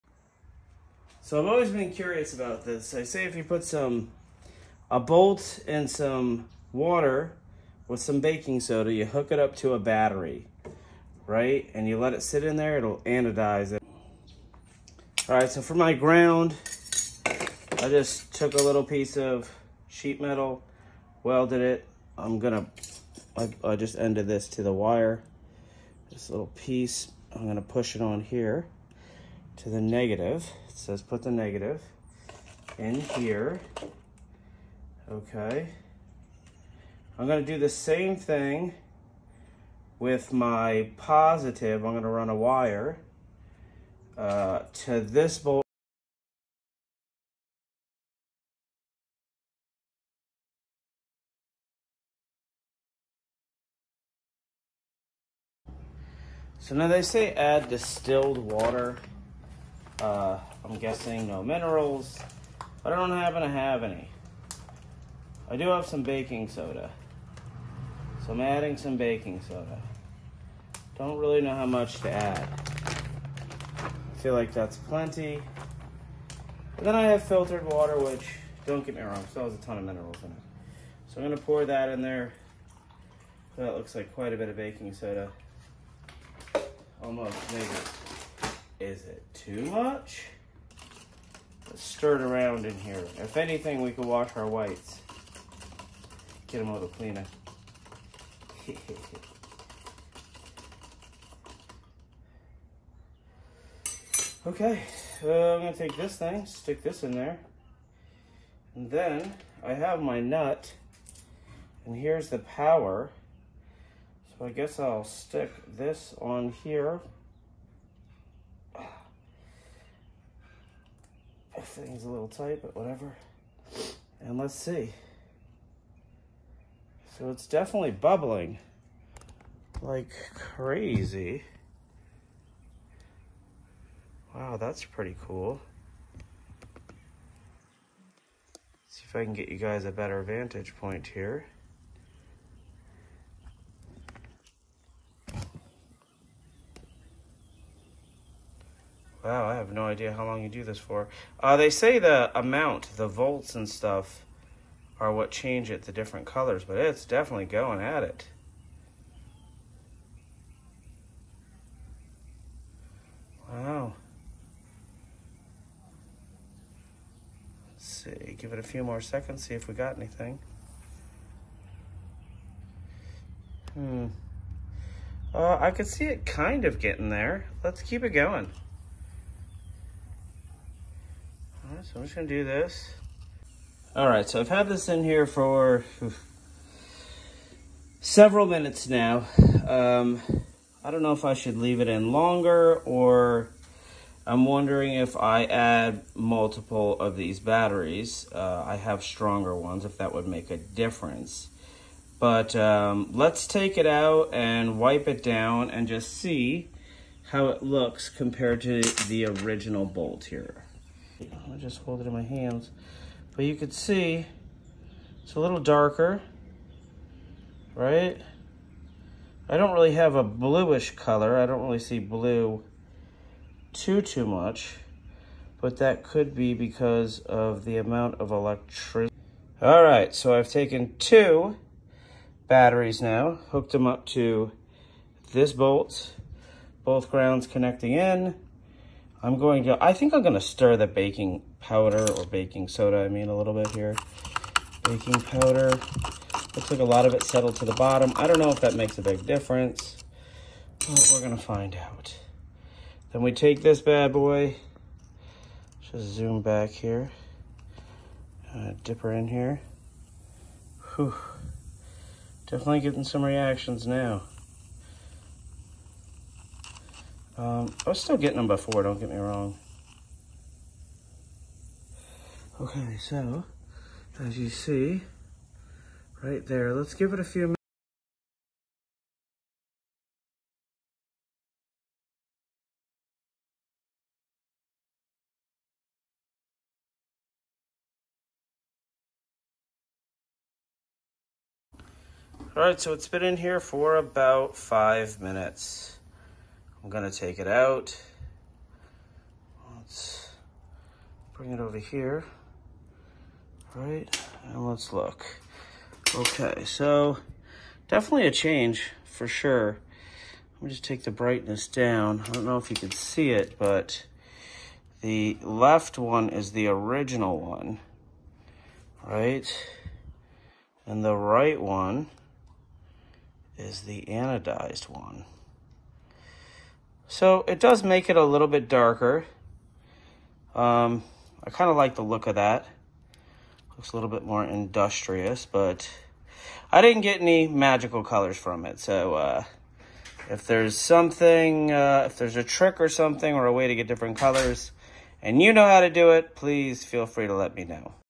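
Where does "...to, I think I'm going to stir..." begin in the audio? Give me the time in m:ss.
3:59.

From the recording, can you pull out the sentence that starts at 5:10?
Let me just take the brightness down.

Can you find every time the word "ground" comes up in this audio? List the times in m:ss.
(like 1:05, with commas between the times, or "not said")
0:15, 3:57.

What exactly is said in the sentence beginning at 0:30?
It says put the negative in here.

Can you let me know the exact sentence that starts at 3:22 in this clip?
But um, let's take it out and wipe it down and just see how it looks compared to the original bolt here.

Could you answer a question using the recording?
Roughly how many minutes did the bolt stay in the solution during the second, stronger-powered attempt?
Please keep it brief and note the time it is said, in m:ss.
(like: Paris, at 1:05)
5, at 4:54.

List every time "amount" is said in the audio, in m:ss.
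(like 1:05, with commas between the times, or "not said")
2:32, 3:47.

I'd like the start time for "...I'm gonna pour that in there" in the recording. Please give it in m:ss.
1:21.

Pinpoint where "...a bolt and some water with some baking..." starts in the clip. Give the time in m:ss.
0:04.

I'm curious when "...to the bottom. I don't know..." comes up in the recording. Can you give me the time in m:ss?
4:07.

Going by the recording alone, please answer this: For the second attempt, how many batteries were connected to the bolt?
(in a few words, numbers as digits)
2.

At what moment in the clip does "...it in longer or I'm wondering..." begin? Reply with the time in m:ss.
3:11.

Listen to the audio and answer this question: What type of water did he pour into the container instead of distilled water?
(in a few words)
filtered water.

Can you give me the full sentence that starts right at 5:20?
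And the right one is the anodized one.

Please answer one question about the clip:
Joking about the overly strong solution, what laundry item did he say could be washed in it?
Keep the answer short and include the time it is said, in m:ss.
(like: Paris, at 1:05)
whites, at 1:34.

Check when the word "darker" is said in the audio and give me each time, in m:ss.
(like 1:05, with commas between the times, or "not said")
3:35, 5:28.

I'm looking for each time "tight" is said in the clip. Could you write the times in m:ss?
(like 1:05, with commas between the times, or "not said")
2:02.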